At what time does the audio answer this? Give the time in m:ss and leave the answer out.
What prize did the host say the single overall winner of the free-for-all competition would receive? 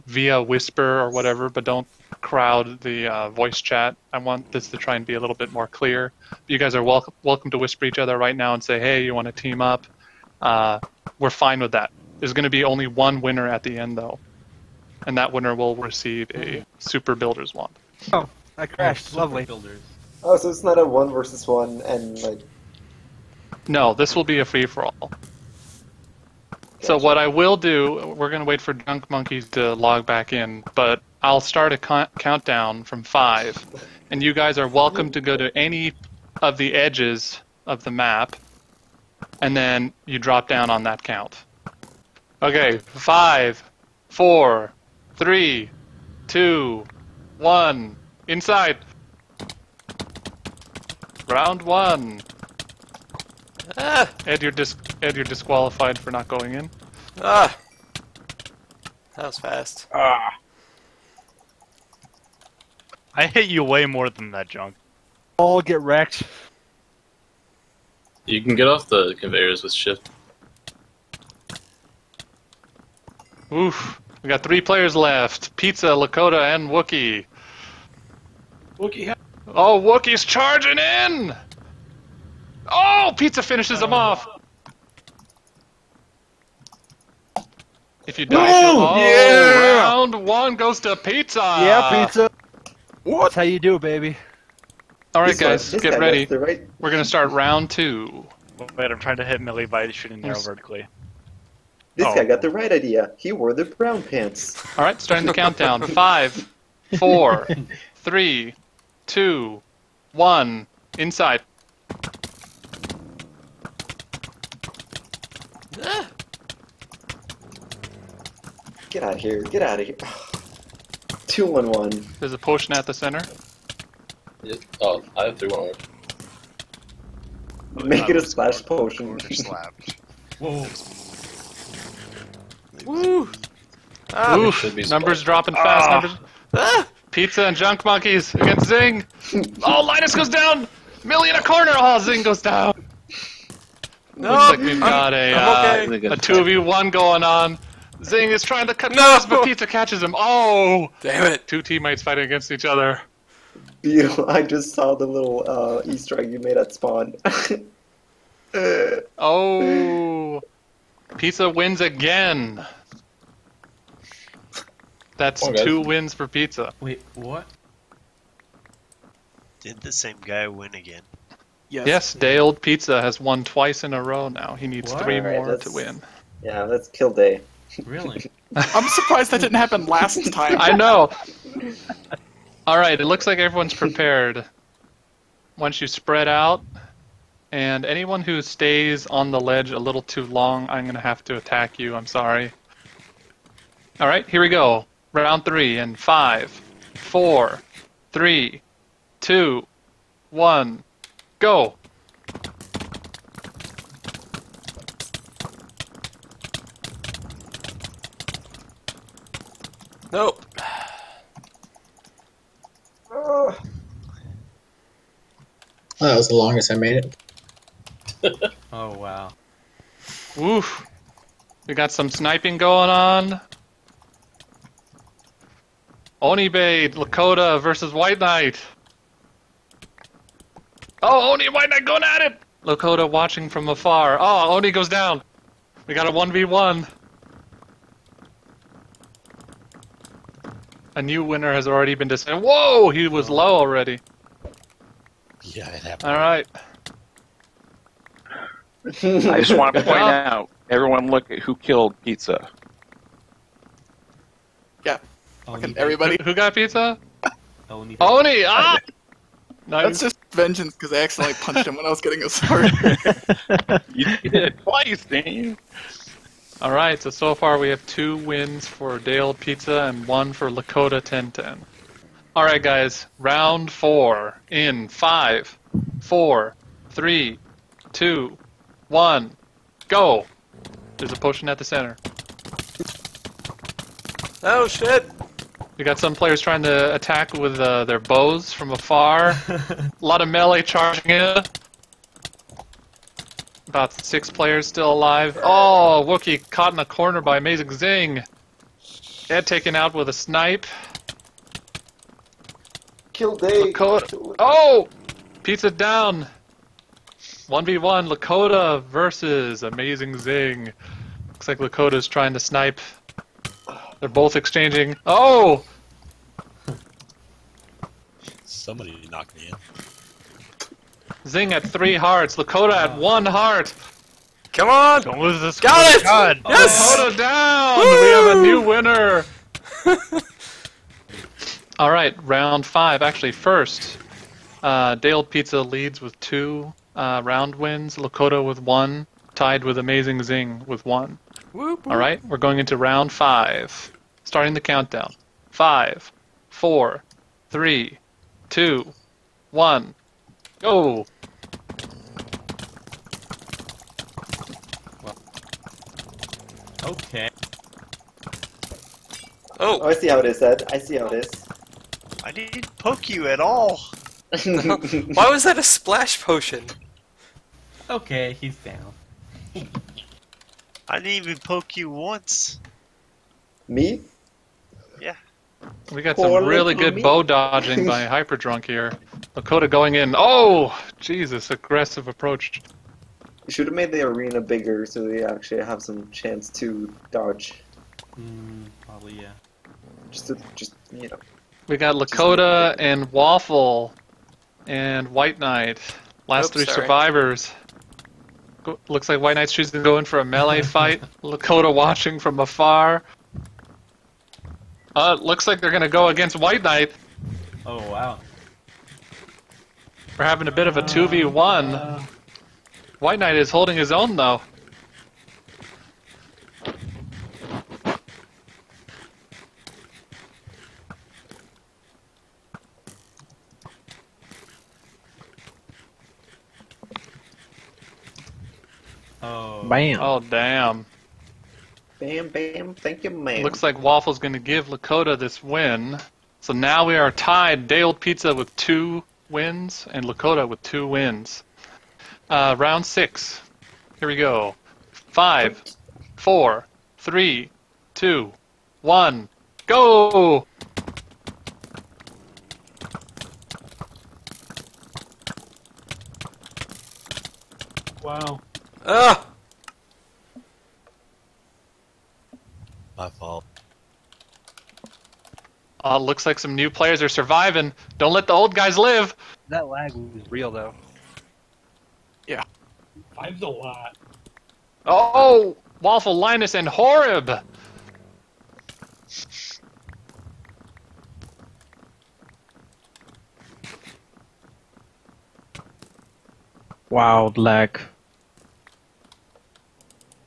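0:16.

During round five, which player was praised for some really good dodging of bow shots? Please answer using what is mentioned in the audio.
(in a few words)
Hyperdrunk.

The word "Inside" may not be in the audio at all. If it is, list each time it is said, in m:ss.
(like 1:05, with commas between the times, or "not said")
0:48, 1:50.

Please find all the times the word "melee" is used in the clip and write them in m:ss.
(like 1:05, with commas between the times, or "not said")
4:50, 6:40.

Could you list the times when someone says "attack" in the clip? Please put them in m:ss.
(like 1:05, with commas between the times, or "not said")
3:11, 4:46.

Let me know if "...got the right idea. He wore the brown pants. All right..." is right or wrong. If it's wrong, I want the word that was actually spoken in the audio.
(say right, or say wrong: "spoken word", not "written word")
right.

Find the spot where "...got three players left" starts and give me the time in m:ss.
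1:14.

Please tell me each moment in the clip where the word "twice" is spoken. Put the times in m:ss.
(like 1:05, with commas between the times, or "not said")
2:53, 4:24.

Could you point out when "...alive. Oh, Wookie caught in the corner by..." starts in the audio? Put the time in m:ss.
4:54.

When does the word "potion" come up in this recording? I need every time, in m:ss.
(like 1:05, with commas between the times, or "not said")
2:02, 2:08, 4:41, 6:06.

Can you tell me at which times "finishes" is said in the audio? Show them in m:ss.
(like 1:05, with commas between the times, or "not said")
1:23.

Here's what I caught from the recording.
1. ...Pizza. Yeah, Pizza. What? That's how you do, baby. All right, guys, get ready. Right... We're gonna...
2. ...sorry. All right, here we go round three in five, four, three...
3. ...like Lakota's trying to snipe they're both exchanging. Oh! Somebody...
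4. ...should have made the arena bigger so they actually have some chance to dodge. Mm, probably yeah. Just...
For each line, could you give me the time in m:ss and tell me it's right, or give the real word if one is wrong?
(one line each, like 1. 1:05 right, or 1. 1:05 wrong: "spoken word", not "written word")
1. 1:30 right
2. 3:12 right
3. 5:11 right
4. 6:23 right.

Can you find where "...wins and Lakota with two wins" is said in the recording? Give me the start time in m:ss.
7:19.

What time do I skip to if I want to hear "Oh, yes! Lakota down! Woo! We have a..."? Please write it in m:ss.
5:26.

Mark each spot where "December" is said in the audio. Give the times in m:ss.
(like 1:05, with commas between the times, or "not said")
not said.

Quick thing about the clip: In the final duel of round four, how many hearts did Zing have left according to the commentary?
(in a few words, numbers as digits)
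3.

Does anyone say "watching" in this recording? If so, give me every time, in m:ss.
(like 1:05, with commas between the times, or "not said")
3:53, 6:41.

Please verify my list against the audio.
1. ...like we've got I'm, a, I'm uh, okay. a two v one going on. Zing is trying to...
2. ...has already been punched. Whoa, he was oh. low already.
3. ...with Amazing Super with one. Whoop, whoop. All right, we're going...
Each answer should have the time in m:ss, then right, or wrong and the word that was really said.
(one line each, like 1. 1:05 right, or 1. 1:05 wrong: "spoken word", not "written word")
1. 2:24 right
2. 4:01 wrong: "decided", not "punched"
3. 5:39 wrong: "Zing", not "Super".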